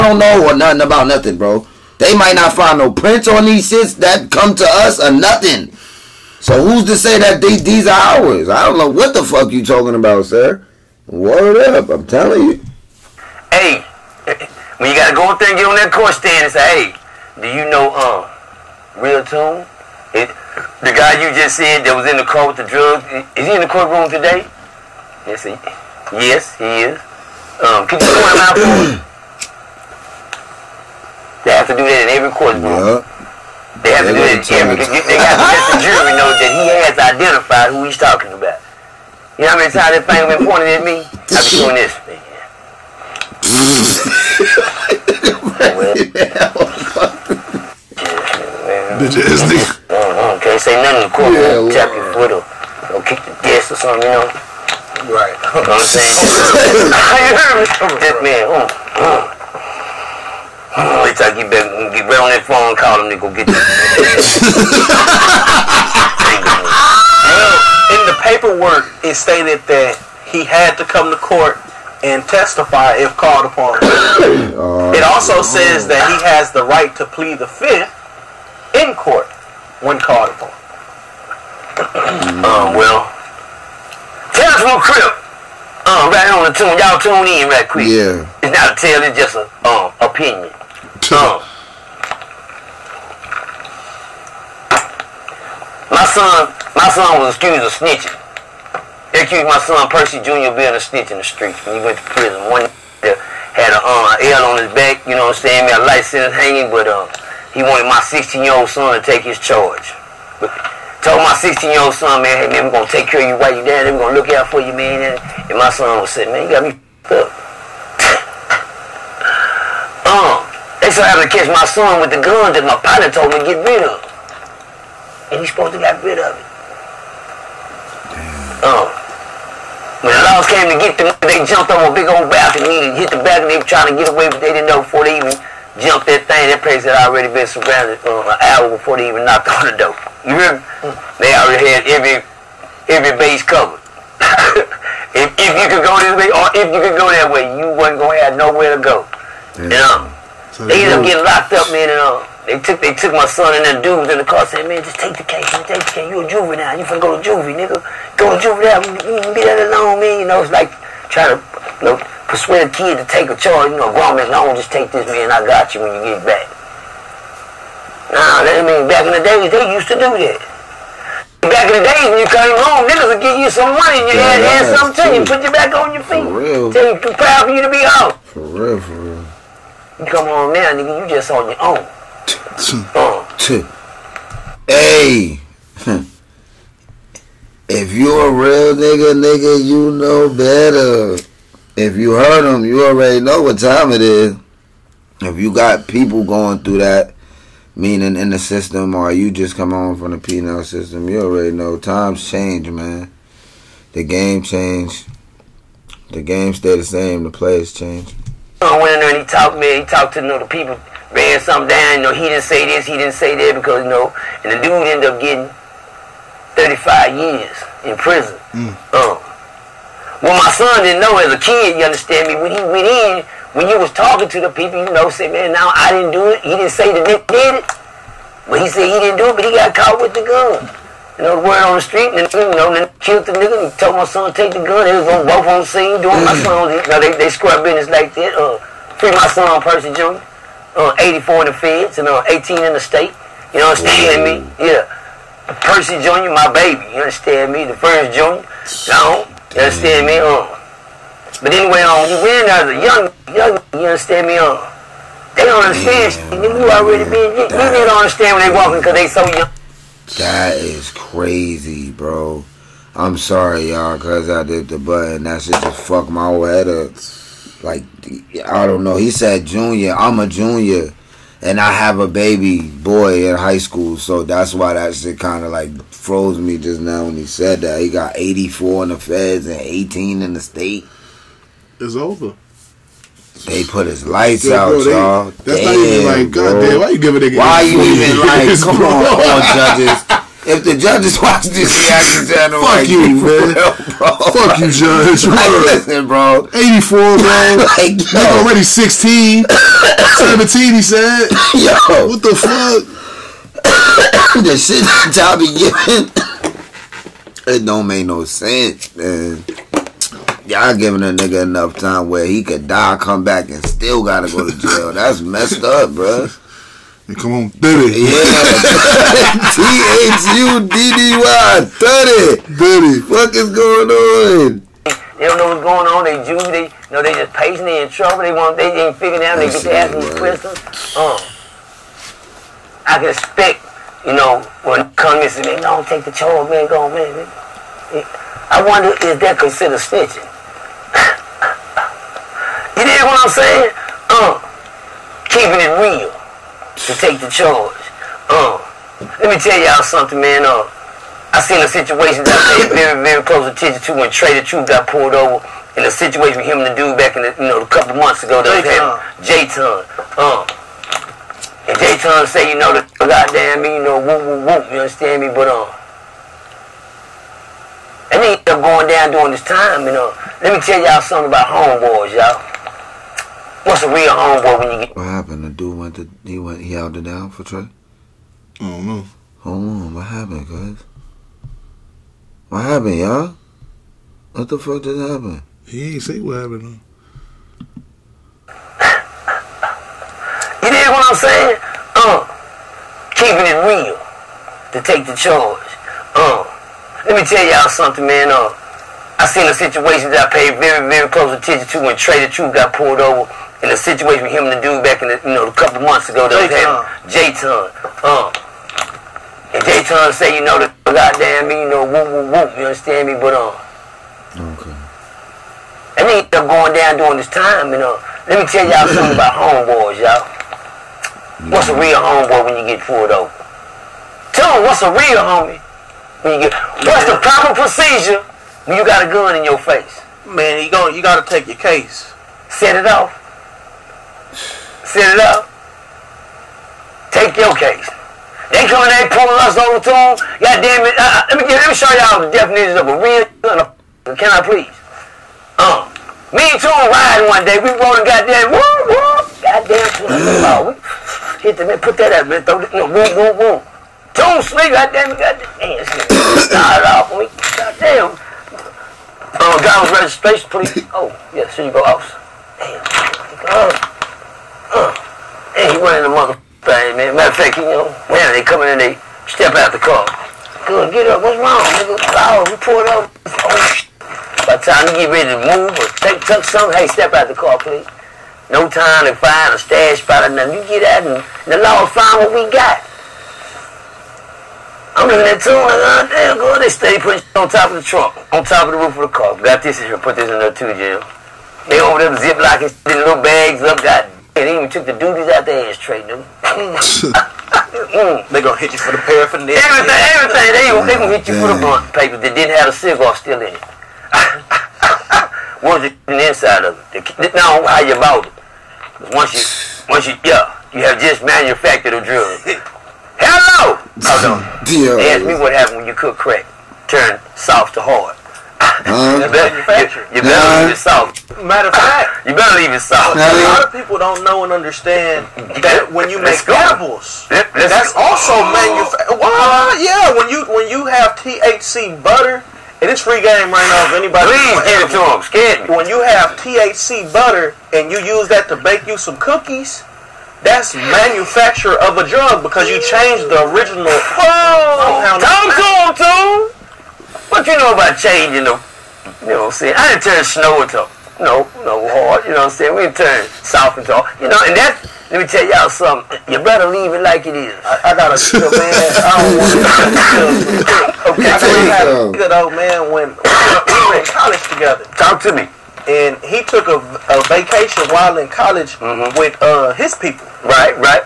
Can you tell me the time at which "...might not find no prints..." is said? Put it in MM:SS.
00:02.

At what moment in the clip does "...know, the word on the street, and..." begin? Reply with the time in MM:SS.
03:51.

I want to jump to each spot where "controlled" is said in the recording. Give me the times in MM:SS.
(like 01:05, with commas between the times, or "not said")
not said.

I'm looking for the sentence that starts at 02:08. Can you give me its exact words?
Um, when the laws came to get them, they jumped on a big old balcony and hit the balcony.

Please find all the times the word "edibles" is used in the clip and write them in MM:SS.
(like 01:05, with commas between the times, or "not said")
08:46.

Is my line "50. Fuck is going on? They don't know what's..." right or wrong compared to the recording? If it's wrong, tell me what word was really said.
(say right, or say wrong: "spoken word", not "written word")
wrong: "30", not "50".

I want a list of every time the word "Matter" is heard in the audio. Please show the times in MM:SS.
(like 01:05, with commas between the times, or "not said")
07:47, 08:41.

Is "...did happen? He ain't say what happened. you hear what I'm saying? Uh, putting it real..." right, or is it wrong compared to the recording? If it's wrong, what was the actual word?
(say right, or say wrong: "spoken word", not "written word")
wrong: "keeping", not "putting".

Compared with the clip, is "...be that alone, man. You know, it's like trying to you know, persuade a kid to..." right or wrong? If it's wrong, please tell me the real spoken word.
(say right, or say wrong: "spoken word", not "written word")
right.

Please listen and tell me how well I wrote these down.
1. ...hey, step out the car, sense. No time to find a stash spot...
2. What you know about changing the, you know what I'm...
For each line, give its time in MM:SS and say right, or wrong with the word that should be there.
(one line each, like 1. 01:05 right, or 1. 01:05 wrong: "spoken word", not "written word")
1. 07:56 wrong: "please", not "sense"
2. 09:07 right.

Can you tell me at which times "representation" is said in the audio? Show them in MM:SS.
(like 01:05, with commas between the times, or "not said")
not said.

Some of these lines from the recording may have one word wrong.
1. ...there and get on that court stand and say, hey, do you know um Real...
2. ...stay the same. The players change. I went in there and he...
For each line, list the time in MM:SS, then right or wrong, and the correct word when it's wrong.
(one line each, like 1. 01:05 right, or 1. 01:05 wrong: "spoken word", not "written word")
1. 00:15 right
2. 03:26 right.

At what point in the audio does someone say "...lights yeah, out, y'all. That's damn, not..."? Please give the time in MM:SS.
04:44.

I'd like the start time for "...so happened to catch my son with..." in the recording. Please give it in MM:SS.
02:00.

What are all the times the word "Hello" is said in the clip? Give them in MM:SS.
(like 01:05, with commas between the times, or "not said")
08:33.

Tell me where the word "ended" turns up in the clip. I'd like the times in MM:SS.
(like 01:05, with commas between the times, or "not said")
02:30, 03:34, 06:08.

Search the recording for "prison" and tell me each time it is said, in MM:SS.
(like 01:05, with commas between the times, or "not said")
01:42, 03:37.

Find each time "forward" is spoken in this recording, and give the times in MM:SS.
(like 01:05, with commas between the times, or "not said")
not said.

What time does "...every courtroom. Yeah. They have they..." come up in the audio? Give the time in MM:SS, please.
00:32.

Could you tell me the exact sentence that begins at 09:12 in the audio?
We didn't turn south into, you know, and that, let me tell y'all something.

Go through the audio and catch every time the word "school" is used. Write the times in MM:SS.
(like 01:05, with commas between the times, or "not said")
04:33.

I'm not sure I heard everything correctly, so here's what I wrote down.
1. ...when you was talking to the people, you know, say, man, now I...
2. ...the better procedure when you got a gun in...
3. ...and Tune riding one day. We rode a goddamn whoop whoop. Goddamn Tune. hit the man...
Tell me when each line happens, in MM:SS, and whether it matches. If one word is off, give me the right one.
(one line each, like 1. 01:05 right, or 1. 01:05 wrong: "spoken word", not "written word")
1. 03:43 right
2. 07:07 wrong: "proper", not "better"
3. 07:26 right.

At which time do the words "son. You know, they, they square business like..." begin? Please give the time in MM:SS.
03:56.